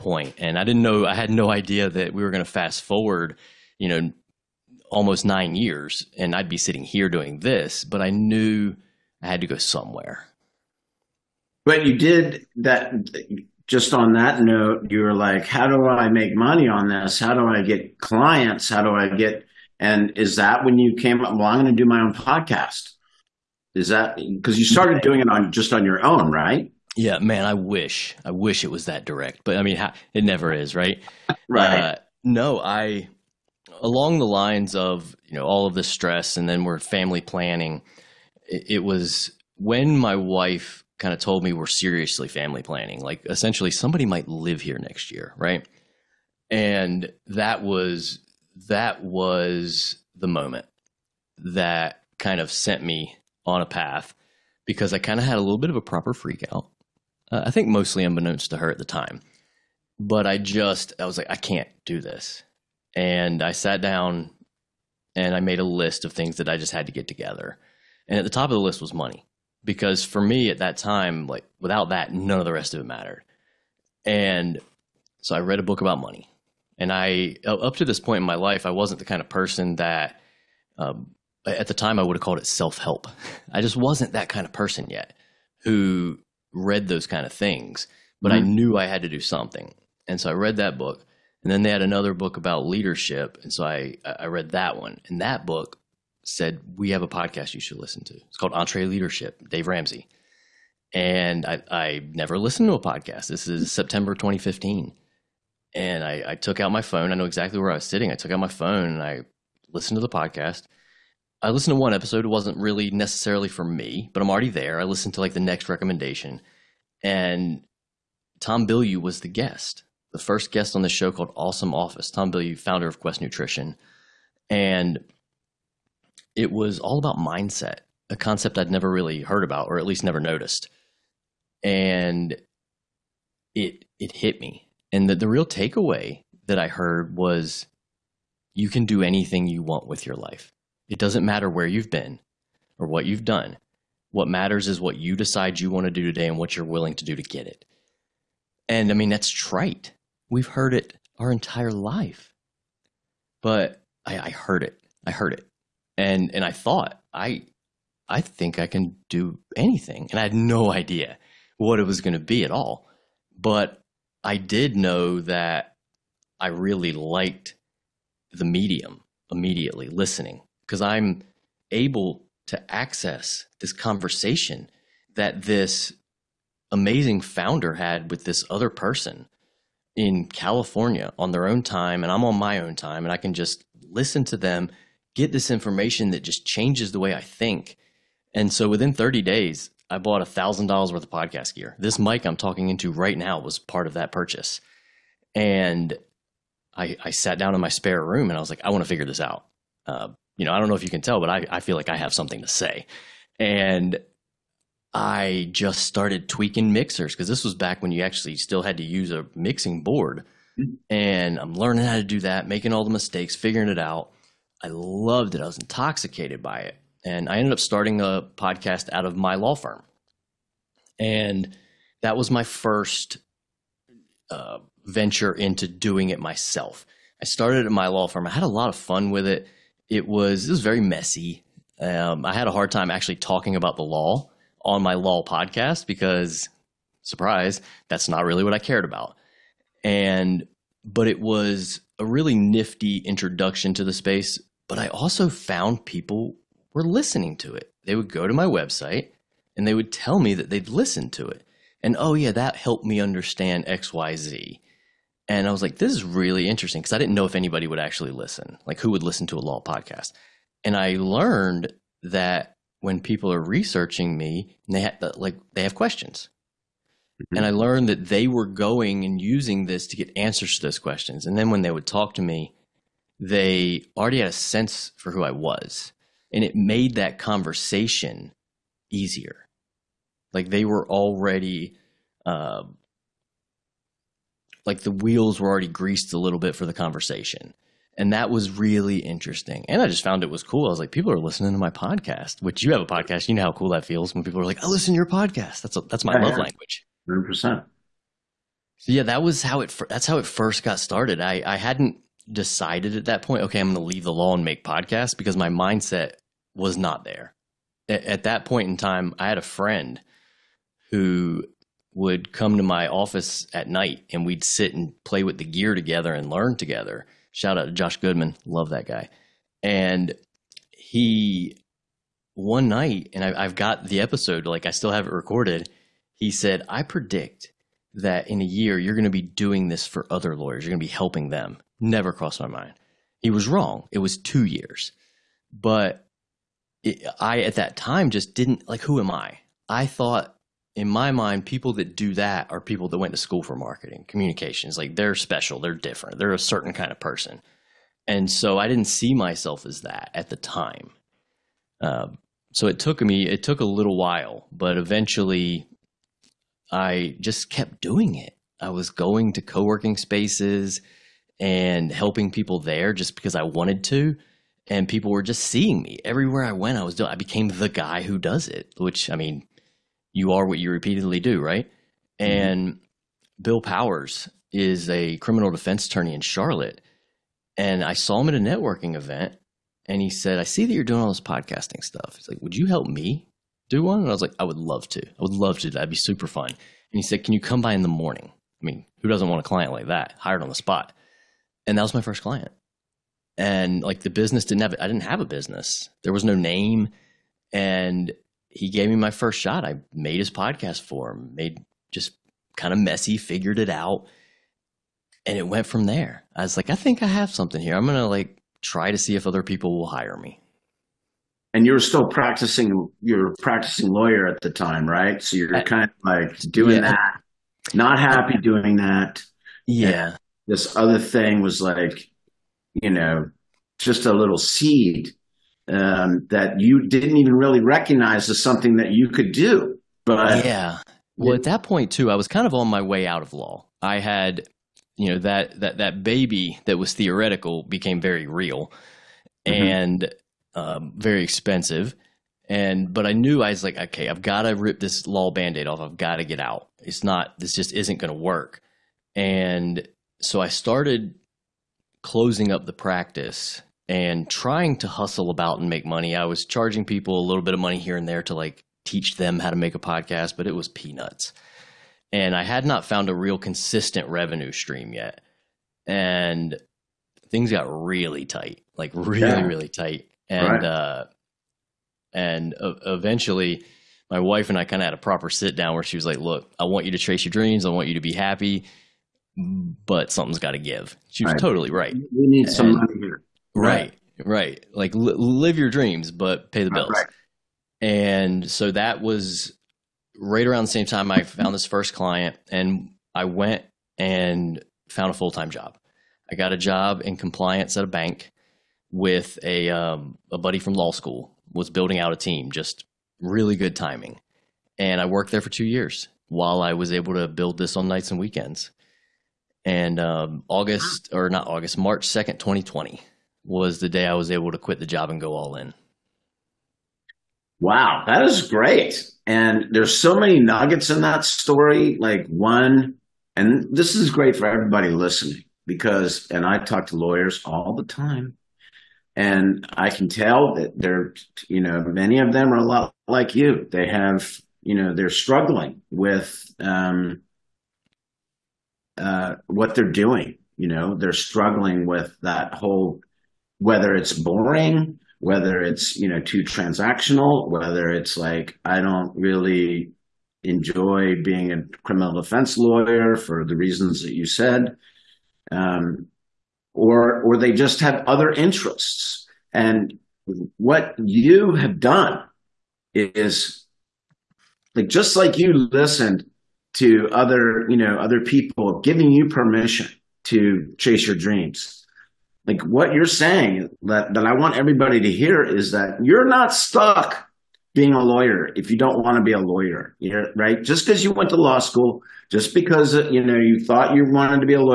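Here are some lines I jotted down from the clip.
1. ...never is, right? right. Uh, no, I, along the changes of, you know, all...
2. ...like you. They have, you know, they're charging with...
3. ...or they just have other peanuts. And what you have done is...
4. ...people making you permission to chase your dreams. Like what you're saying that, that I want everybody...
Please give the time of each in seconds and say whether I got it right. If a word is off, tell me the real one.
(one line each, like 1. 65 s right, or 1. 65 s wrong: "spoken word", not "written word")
1. 30 s wrong: "lines", not "changes"
2. 533 s wrong: "struggling", not "charging"
3. 557 s wrong: "interests", not "peanuts"
4. 568 s wrong: "giving", not "making".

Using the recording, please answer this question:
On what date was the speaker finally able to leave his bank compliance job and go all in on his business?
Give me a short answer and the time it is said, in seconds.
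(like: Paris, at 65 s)
March 2, 2020, at 511 s.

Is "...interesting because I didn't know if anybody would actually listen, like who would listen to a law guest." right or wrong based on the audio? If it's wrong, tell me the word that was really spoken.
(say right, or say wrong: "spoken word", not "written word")
wrong: "podcast", not "guest".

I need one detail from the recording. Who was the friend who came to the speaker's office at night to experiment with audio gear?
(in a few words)
Josh Goodman.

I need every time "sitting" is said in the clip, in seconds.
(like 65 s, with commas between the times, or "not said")
6 s, 107 s.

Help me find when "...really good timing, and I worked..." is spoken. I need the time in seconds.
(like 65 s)
503 s.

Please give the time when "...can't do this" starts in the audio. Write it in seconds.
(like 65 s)
61 s.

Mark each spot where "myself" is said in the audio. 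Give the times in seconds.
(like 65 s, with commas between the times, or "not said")
226 s, 349 s.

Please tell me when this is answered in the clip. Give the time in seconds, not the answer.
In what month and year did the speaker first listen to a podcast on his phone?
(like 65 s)
103 s.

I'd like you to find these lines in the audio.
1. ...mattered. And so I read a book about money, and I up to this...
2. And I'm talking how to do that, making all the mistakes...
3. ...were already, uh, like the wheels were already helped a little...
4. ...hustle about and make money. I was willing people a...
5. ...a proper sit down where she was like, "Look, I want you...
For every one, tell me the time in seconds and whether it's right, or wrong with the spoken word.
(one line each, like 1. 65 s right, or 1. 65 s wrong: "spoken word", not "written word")
1. 72 s right
2. 210 s wrong: "learning", not "talking"
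3. 280 s wrong: "greased", not "helped"
4. 454 s wrong: "charging", not "willing"
5. 474 s right.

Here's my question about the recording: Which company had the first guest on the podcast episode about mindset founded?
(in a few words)
Quest Nutrition.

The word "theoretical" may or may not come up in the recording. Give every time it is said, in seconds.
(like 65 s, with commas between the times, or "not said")
436 s.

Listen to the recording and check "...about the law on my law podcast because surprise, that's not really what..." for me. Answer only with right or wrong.
right.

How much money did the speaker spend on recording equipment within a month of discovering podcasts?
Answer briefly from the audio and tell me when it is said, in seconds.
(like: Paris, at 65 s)
$1,000, at 190 s.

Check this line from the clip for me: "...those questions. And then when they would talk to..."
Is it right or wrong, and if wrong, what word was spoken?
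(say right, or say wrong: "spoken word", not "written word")
right.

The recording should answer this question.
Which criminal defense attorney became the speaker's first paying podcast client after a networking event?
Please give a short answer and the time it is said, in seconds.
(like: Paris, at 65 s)
Bill Powers, at 373 s.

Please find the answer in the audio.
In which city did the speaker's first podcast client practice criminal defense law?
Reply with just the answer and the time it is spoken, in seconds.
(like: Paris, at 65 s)
Charlotte, at 376 s.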